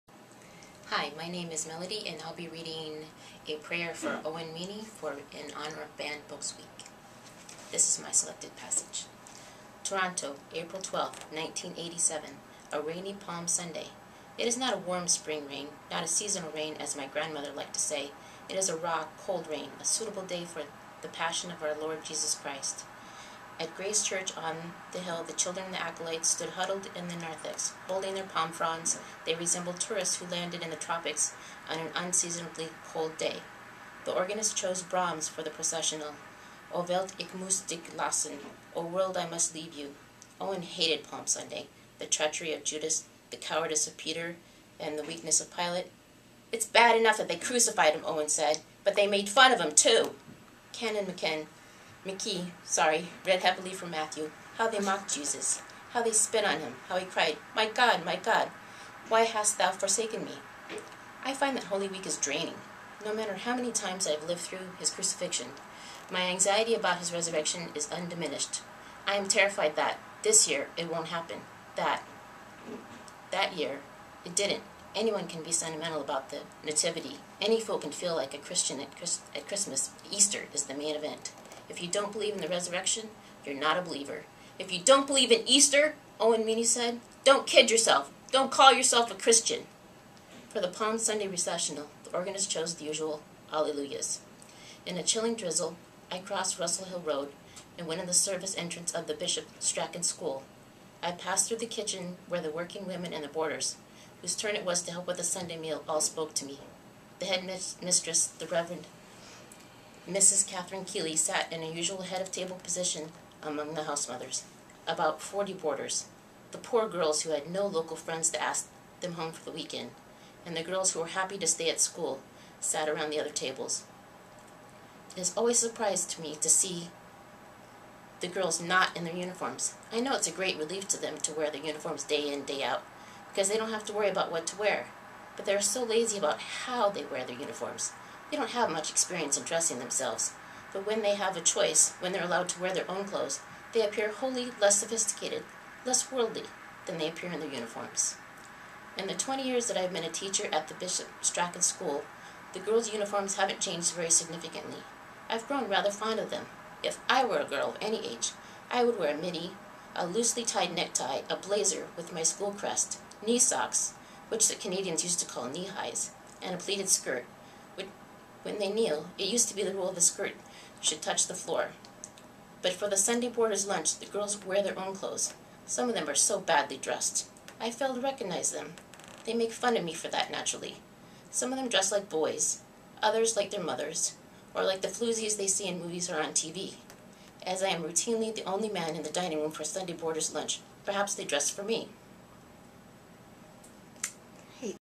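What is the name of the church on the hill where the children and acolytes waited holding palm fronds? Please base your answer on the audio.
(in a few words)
Grace Church.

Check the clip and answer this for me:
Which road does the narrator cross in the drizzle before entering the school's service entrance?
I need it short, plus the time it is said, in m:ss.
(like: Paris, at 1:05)
Russell Hill Road, at 1:36.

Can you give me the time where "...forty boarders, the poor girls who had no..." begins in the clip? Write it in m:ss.
1:55.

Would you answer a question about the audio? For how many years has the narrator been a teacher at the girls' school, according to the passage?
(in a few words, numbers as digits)
20.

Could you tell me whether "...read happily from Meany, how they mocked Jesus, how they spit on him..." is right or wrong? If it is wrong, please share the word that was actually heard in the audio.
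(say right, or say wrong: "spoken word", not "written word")
wrong: "Matthew", not "Meany".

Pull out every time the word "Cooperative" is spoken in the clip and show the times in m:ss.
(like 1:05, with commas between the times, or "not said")
not said.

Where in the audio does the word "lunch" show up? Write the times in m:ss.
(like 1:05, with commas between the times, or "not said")
2:53, 3:10.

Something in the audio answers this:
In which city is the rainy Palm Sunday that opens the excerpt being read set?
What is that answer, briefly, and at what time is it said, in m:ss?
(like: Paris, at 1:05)
Toronto, at 0:09.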